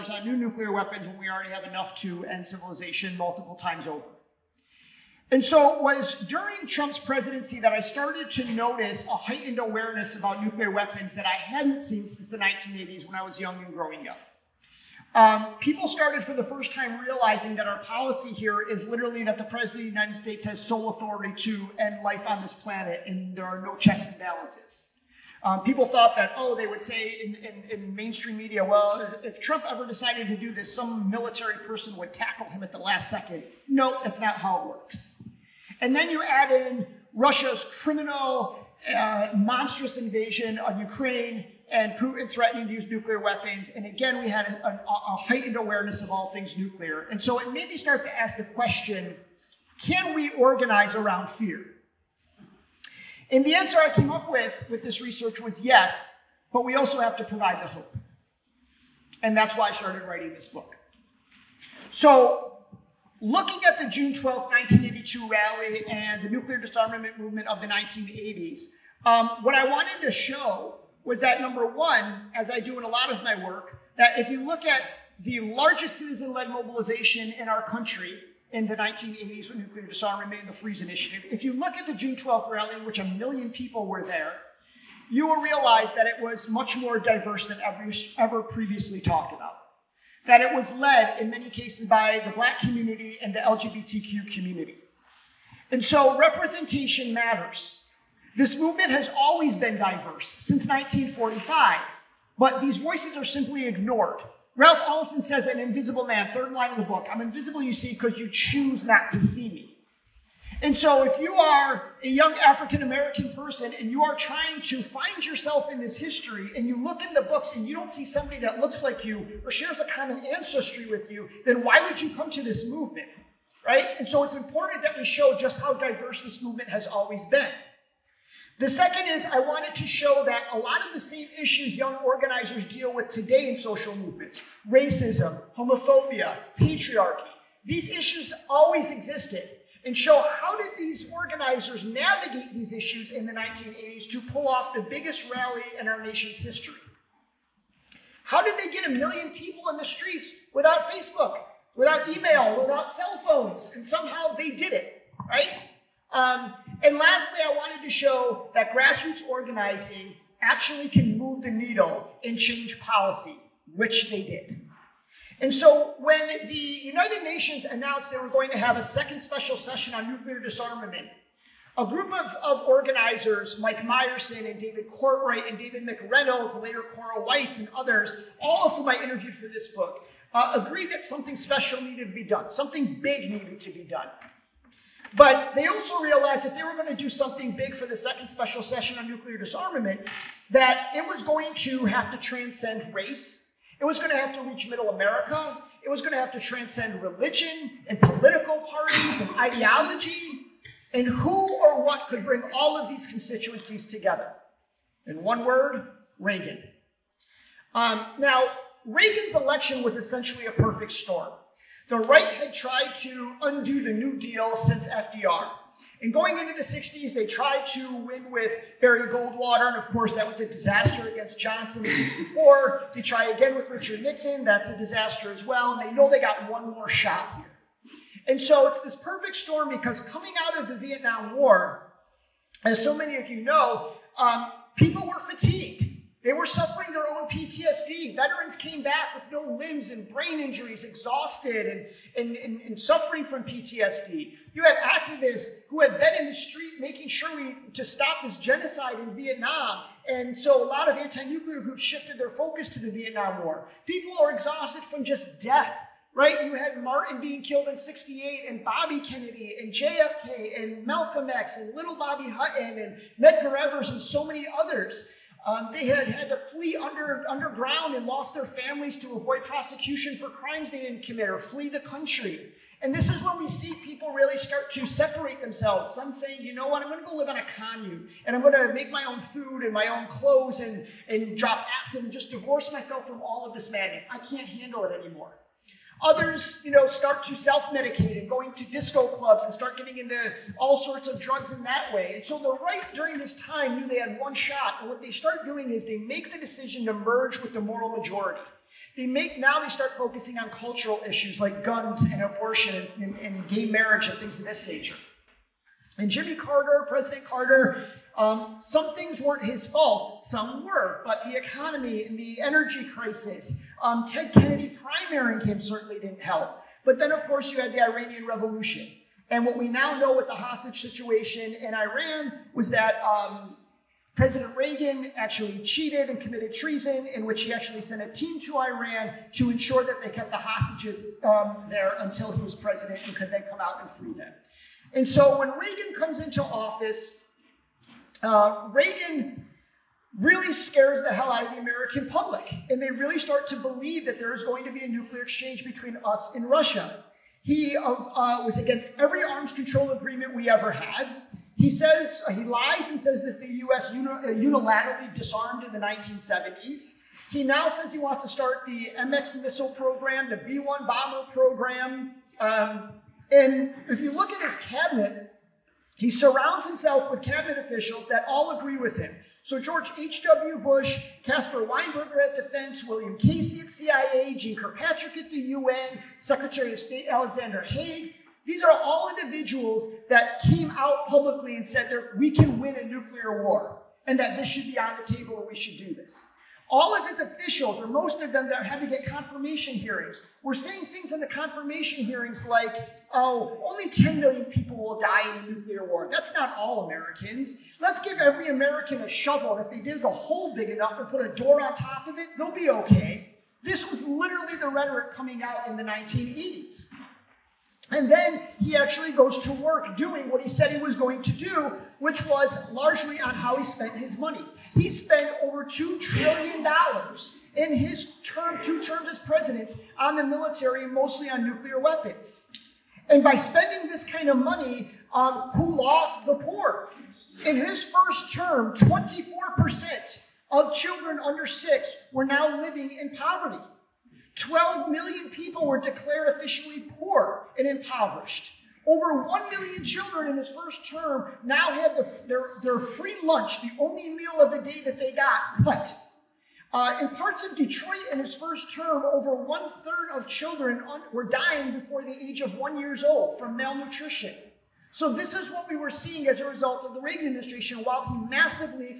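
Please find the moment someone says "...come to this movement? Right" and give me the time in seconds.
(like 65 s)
122 s.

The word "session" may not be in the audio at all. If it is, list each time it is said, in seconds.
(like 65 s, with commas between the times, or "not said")
169 s, 188 s.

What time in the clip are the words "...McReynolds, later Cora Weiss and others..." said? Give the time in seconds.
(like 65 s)
175 s.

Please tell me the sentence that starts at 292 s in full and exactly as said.
And so the right during this time knew they had one shot.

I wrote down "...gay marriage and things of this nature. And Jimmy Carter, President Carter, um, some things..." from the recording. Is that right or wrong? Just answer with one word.
right.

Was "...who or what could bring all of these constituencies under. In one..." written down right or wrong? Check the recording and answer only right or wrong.
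wrong.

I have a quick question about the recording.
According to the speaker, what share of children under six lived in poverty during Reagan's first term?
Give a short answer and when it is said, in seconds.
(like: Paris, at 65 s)
24%, at 428 s.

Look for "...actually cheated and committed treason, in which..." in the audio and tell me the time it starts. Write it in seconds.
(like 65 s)
325 s.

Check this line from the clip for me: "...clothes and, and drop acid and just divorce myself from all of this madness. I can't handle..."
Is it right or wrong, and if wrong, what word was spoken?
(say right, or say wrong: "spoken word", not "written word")
right.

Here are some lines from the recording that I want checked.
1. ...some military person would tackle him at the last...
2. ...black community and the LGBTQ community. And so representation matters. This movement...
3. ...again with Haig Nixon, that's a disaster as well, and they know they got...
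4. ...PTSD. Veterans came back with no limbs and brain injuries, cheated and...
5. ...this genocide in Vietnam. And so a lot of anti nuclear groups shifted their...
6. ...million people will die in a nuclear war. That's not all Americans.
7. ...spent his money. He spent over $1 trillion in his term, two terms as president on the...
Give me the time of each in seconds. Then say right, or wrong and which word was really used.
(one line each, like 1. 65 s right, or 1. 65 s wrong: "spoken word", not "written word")
1. 30 s right
2. 92 s right
3. 223 s wrong: "Richard", not "Haig"
4. 237 s wrong: "exhausted", not "cheated"
5. 248 s right
6. 394 s right
7. 413 s wrong: "2", not "1".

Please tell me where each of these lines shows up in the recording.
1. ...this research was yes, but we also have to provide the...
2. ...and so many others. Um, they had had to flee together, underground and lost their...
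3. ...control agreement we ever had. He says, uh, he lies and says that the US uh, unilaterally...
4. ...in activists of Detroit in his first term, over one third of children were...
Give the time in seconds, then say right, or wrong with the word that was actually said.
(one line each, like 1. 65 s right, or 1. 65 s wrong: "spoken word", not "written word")
1. 54 s right
2. 263 s wrong: "under", not "together"
3. 349 s right
4. 446 s wrong: "parts", not "activists".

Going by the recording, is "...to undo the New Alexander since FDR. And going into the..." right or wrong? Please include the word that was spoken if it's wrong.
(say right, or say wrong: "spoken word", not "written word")
wrong: "Deal", not "Alexander".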